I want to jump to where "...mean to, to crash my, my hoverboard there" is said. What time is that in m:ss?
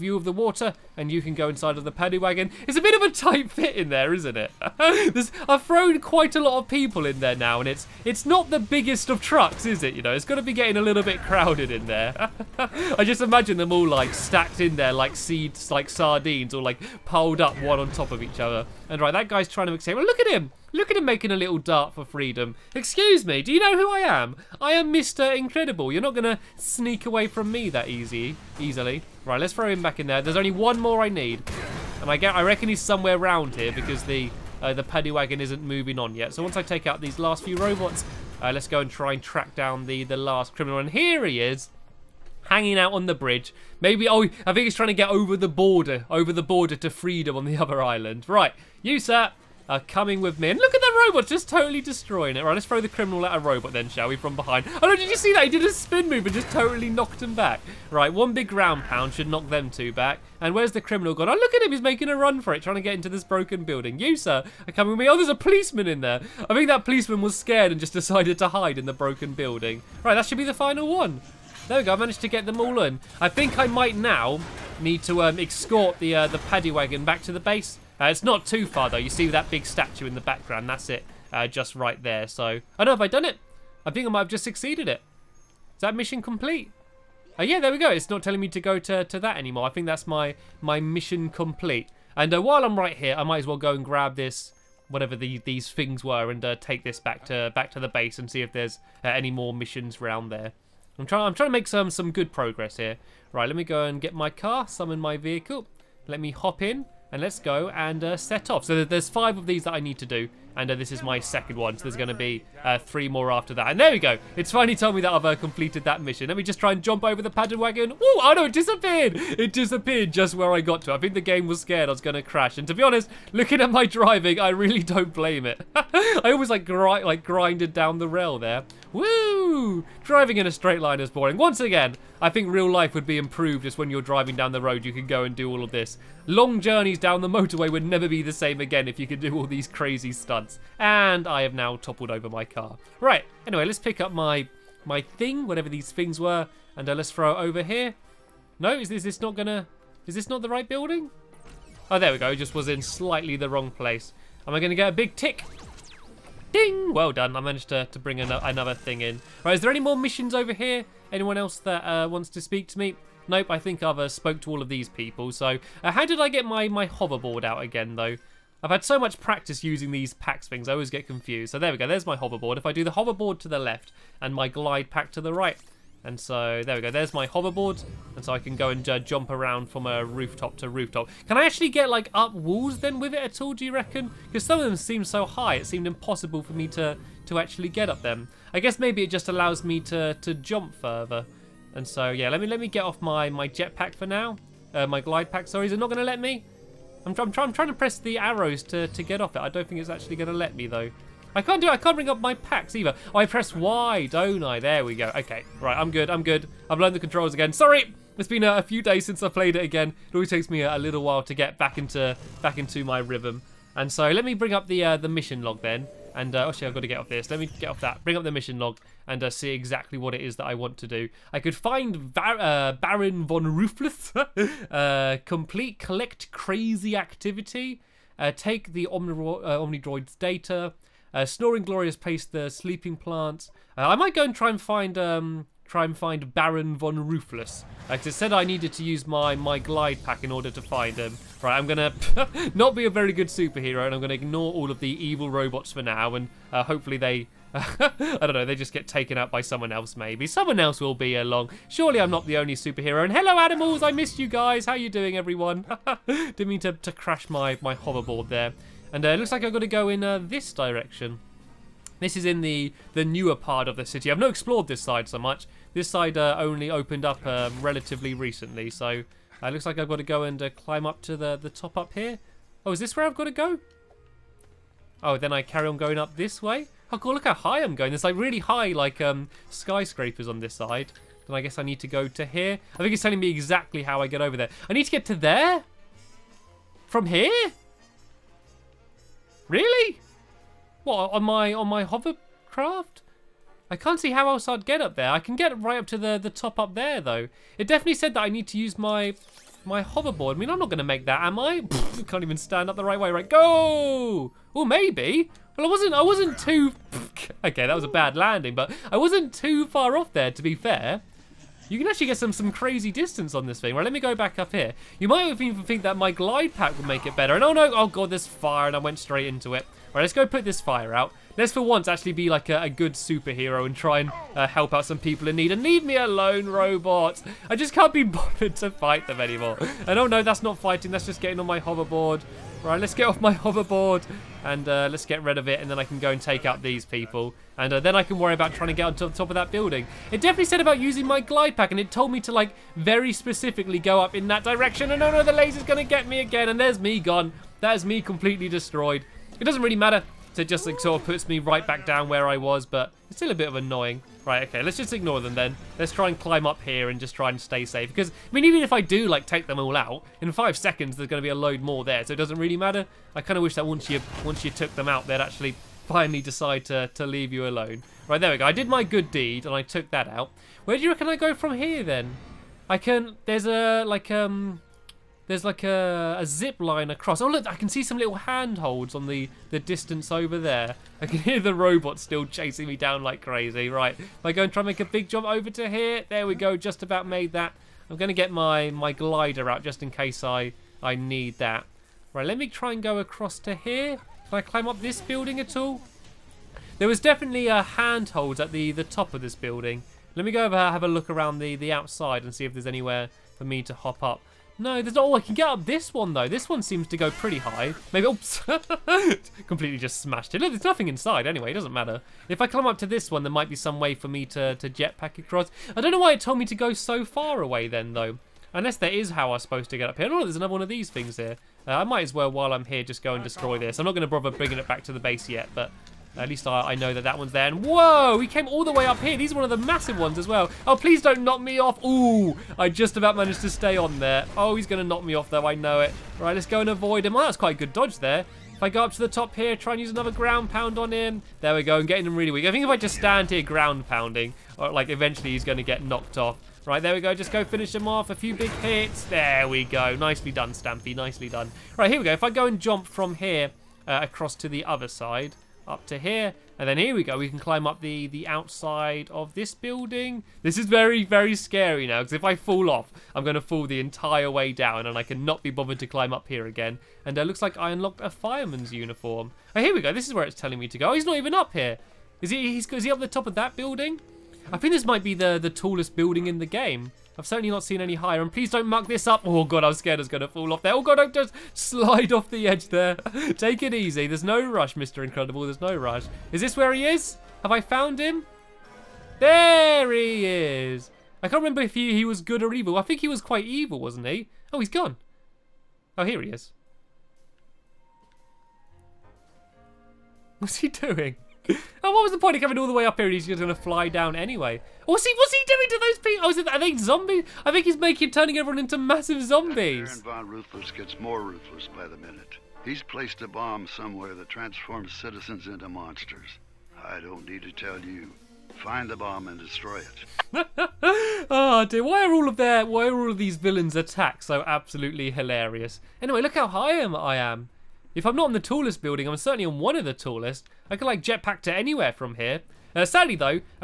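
4:16.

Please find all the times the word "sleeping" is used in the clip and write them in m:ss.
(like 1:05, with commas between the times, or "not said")
3:52.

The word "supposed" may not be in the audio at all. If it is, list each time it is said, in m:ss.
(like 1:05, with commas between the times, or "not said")
6:59.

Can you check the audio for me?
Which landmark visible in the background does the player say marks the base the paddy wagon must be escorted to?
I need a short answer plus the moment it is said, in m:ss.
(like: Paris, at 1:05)
big statue, at 1:19.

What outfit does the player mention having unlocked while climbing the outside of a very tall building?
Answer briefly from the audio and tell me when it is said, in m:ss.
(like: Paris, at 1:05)
fireman's uniform, at 7:48.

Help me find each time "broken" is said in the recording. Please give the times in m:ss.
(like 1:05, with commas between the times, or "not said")
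1:03, 1:08.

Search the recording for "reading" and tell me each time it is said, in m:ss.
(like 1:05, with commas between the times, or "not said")
not said.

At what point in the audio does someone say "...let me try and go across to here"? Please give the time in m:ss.
6:32.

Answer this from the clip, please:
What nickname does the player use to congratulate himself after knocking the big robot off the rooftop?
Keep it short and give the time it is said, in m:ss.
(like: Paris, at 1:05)
Stampy, at 7:29.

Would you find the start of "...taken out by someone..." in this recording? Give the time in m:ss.
4:08.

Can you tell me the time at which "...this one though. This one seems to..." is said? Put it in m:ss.
6:45.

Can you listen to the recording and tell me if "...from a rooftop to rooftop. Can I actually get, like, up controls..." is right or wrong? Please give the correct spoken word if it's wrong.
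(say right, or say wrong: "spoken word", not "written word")
wrong: "walls", not "controls".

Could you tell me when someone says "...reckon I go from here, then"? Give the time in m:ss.
6:10.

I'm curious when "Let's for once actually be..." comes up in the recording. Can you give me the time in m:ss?
5:21.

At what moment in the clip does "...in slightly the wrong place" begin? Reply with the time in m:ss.
2:32.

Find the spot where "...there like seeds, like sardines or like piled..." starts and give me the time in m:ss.
0:14.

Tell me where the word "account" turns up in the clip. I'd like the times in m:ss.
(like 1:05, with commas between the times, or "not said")
not said.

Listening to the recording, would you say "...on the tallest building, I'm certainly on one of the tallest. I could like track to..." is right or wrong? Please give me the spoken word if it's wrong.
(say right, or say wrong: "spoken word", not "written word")
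wrong: "jetpack", not "track".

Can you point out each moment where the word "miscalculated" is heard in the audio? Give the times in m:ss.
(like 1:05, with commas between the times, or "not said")
not said.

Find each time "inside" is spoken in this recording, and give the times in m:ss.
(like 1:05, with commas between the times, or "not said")
0:01, 6:50.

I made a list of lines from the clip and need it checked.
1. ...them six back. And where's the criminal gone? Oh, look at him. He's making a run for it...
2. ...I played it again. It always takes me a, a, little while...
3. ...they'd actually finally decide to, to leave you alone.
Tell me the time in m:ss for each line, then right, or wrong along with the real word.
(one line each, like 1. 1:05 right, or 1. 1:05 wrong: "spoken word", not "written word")
1. 0:59 wrong: "two", not "six"
2. 3:29 right
3. 6:05 right.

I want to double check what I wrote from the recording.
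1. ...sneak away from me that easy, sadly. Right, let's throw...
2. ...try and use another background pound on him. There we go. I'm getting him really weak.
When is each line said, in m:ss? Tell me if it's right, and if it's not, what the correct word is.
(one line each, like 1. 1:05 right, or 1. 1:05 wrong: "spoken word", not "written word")
1. 0:26 wrong: "easily", not "sadly"
2. 7:19 wrong: "ground", not "background".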